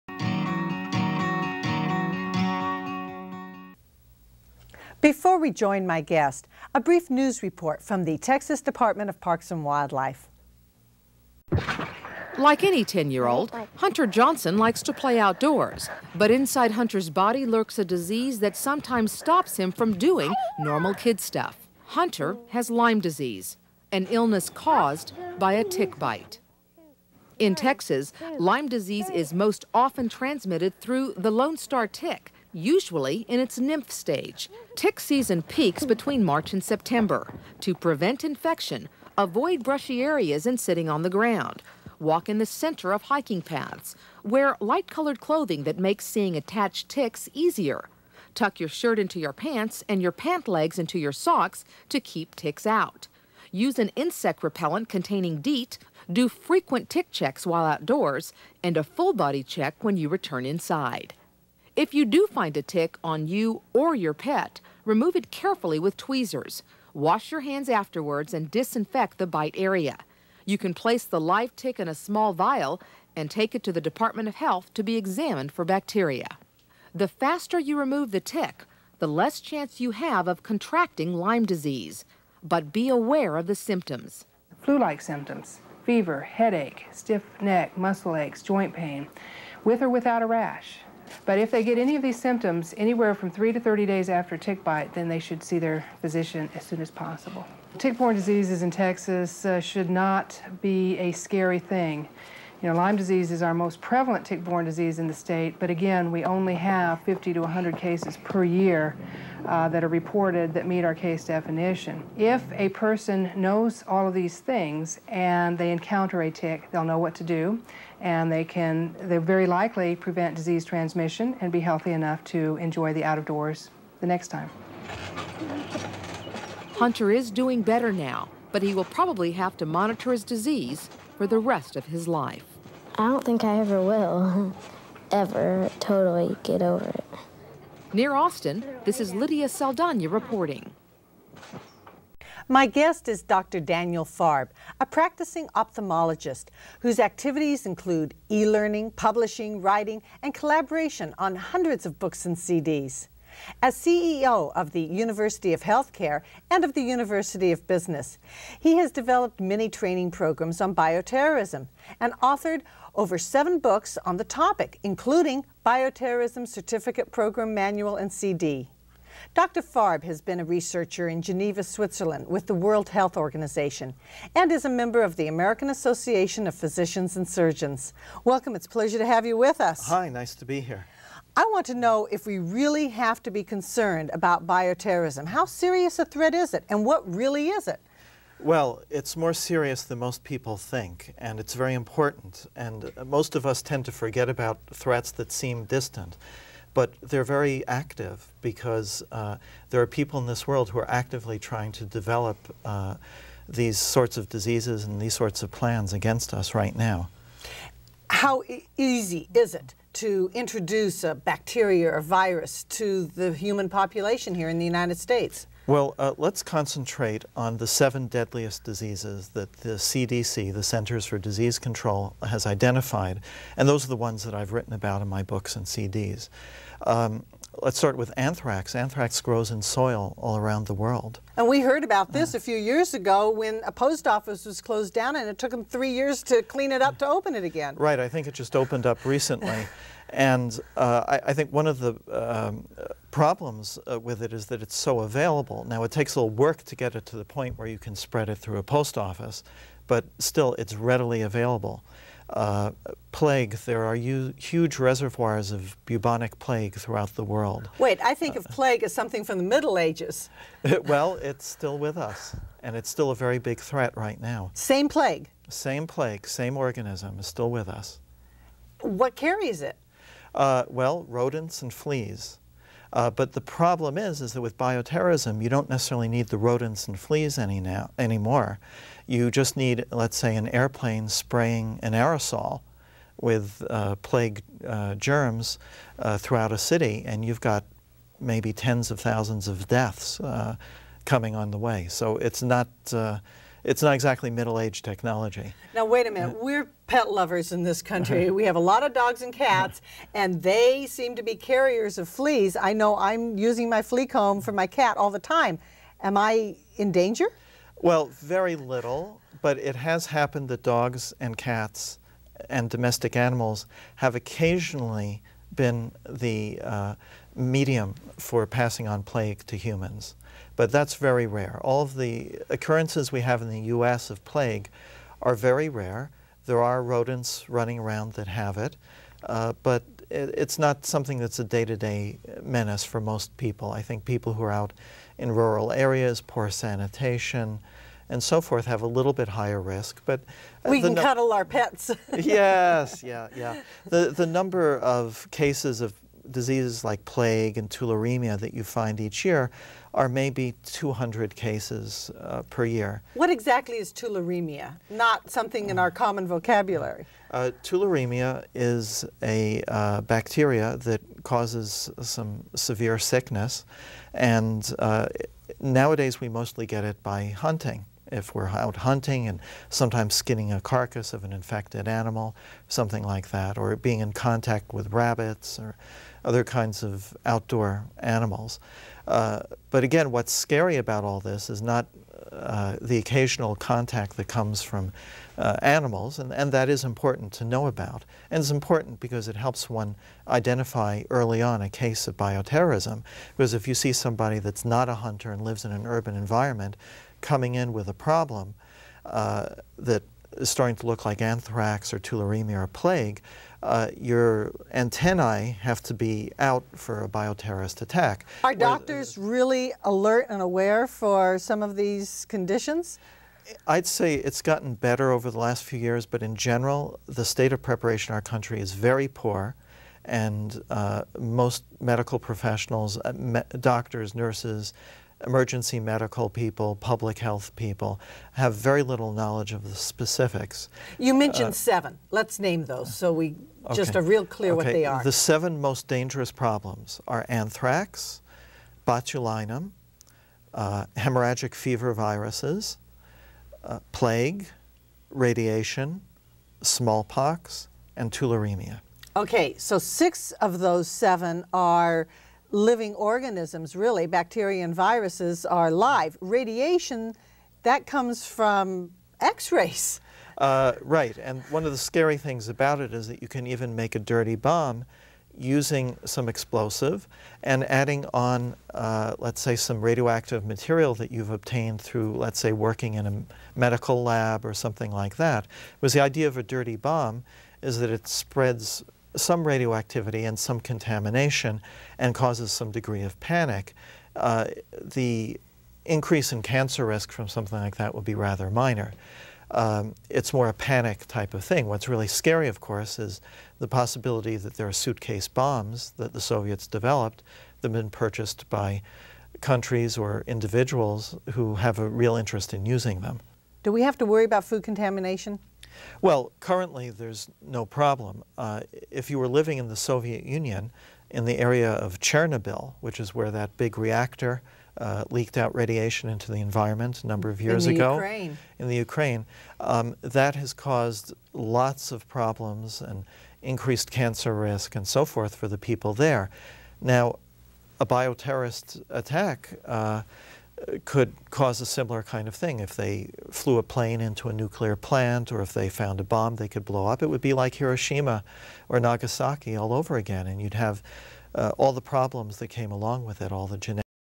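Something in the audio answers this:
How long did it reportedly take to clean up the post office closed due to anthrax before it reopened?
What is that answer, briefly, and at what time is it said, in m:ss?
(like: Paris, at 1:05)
3 years, at 3:55.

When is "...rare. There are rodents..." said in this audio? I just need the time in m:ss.
5:25.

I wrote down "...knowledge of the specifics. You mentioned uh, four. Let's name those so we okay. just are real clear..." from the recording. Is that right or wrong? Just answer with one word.
wrong.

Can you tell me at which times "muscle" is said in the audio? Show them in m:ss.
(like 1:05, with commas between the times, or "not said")
1:27.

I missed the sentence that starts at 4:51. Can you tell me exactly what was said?
So it's not uh, it's not exactly middle-aged technology.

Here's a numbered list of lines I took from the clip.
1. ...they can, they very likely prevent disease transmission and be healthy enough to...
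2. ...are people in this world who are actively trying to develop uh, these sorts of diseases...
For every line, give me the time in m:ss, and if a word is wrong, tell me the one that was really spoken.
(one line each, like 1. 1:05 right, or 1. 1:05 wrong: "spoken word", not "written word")
1. 1:58 right
2. 3:19 right.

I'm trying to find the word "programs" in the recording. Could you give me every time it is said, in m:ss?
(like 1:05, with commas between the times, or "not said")
2:40, 2:47.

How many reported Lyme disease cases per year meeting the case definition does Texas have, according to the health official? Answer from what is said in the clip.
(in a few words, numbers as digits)
50 to 100.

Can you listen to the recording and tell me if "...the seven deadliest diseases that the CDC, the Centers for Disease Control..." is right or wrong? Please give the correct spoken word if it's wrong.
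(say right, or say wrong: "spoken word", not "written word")
right.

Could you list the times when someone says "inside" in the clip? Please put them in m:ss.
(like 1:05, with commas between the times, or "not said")
0:16, 1:00.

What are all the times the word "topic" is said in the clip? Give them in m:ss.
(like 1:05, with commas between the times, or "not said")
2:44.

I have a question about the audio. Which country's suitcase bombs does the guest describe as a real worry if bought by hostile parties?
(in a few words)
Soviet Union.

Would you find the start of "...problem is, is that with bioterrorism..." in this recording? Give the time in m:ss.
4:33.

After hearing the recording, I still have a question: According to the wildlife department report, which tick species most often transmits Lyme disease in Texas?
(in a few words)
Lone Star tick.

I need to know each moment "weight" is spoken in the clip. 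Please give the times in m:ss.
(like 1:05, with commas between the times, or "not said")
not said.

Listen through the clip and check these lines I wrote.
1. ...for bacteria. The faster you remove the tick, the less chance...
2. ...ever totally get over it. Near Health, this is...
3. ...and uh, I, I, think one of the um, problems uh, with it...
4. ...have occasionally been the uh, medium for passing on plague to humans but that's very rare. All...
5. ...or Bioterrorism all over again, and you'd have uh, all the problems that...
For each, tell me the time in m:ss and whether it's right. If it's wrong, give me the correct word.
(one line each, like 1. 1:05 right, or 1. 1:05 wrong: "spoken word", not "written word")
1. 1:15 right
2. 2:15 wrong: "Austin", not "Health"
3. 4:00 right
4. 5:13 right
5. 8:58 wrong: "Nagasaki", not "Bioterrorism".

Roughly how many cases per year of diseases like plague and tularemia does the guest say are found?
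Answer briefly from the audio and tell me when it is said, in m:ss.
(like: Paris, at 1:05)
200, at 5:50.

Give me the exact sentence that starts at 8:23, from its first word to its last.
Do we have to worry about food contamination?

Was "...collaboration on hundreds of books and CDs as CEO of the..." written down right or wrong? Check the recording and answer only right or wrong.
right.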